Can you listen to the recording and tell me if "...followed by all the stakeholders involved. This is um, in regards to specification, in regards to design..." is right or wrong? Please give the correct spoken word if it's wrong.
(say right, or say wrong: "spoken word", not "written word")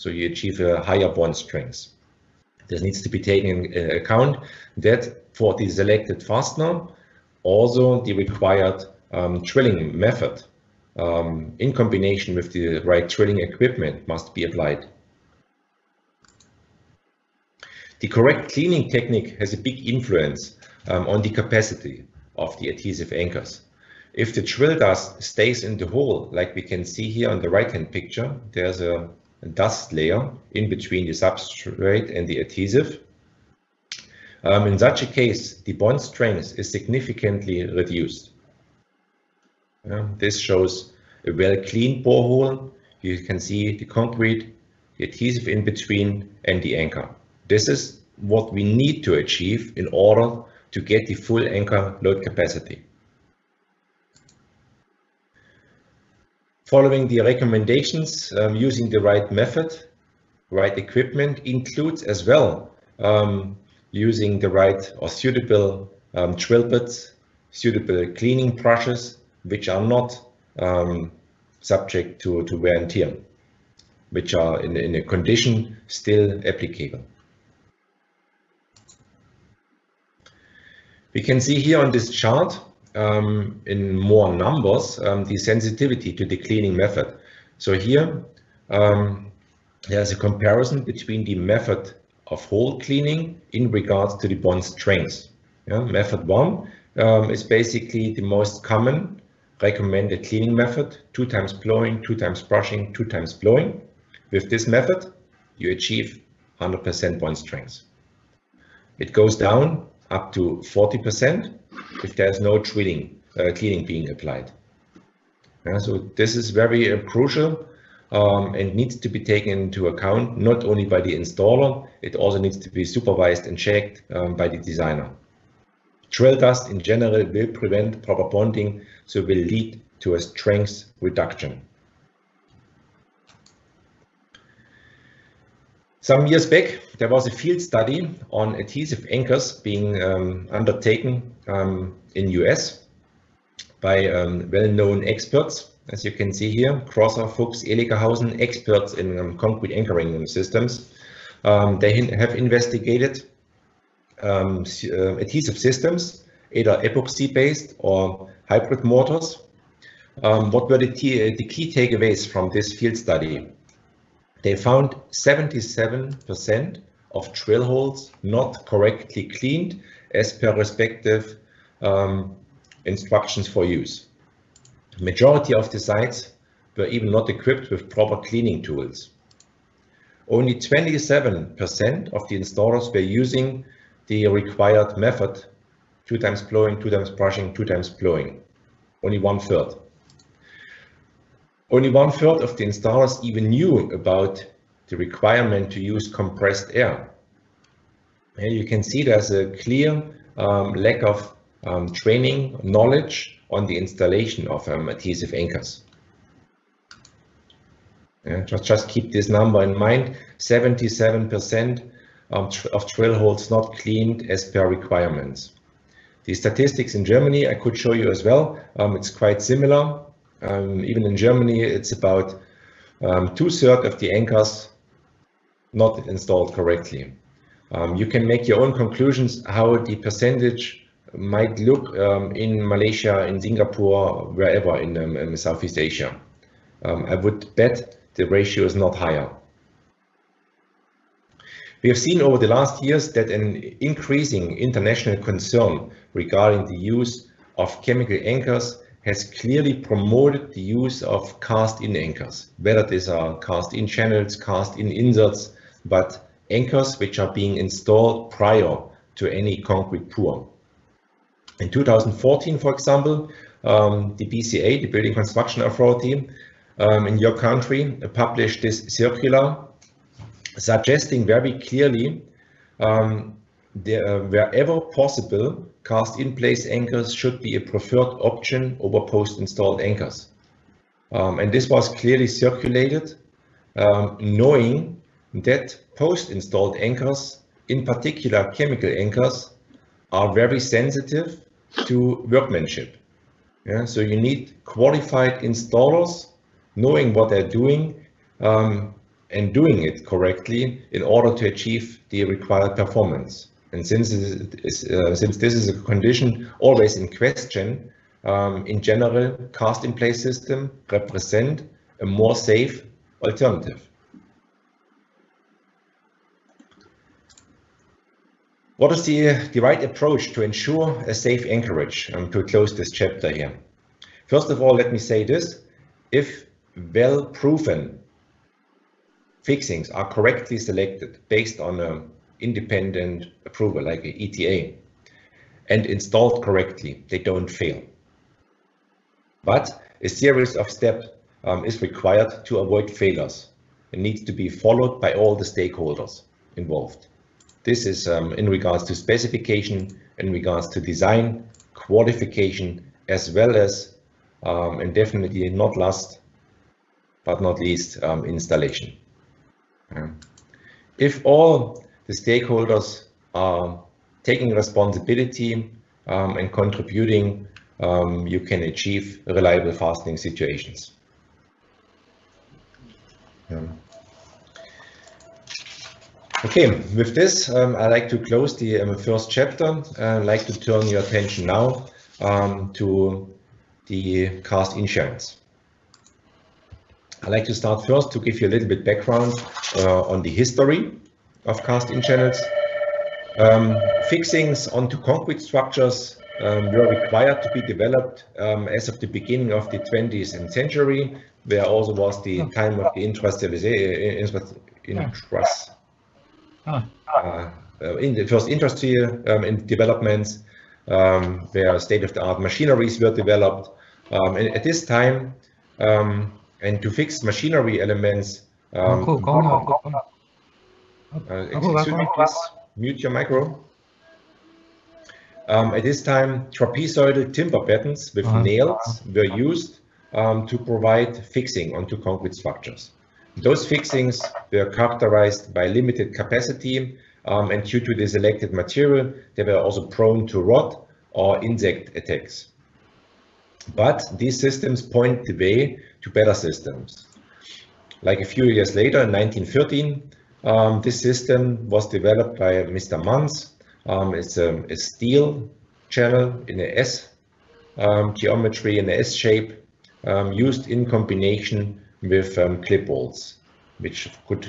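right.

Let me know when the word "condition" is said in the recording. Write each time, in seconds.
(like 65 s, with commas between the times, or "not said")
75 s, 305 s.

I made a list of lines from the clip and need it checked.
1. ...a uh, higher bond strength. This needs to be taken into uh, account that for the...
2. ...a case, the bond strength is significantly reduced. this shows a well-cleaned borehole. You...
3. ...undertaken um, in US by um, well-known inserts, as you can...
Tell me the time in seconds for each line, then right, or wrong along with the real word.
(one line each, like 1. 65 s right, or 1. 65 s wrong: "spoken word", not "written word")
1. 0 s right
2. 35 s right
3. 140 s wrong: "experts", not "inserts".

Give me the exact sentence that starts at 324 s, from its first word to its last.
First of all, let me say this.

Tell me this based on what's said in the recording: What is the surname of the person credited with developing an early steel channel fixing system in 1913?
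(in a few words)
Manns.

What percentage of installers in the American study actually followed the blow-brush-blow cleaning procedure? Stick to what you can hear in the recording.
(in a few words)
27%.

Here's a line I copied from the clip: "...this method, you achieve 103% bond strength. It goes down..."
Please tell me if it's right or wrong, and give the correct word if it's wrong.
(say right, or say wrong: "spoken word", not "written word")
wrong: "100", not "103".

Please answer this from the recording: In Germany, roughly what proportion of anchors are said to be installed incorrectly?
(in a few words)
Two-thirds.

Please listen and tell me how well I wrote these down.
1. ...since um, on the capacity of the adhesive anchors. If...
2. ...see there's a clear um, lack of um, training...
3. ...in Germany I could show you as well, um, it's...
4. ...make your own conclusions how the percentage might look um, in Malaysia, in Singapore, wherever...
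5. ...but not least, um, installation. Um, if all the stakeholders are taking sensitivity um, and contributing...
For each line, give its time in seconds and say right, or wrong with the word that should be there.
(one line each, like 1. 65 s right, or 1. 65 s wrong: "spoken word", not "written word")
1. 19 s wrong: "influence", not "since"
2. 198 s right
3. 216 s right
4. 228 s right
5. 357 s wrong: "responsibility", not "sensitivity".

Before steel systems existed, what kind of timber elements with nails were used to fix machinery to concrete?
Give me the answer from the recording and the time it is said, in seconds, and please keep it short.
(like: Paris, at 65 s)
Trapezoidal timber battens, at 426 s.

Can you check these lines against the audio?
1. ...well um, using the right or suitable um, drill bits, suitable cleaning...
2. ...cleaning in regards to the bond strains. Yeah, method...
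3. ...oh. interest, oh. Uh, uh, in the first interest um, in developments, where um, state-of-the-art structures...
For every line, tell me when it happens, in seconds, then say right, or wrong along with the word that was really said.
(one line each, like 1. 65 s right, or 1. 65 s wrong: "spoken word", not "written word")
1. 62 s right
2. 92 s right
3. 404 s wrong: "machineries", not "structures".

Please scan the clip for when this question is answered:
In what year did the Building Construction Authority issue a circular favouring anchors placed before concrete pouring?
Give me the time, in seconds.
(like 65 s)
261 s.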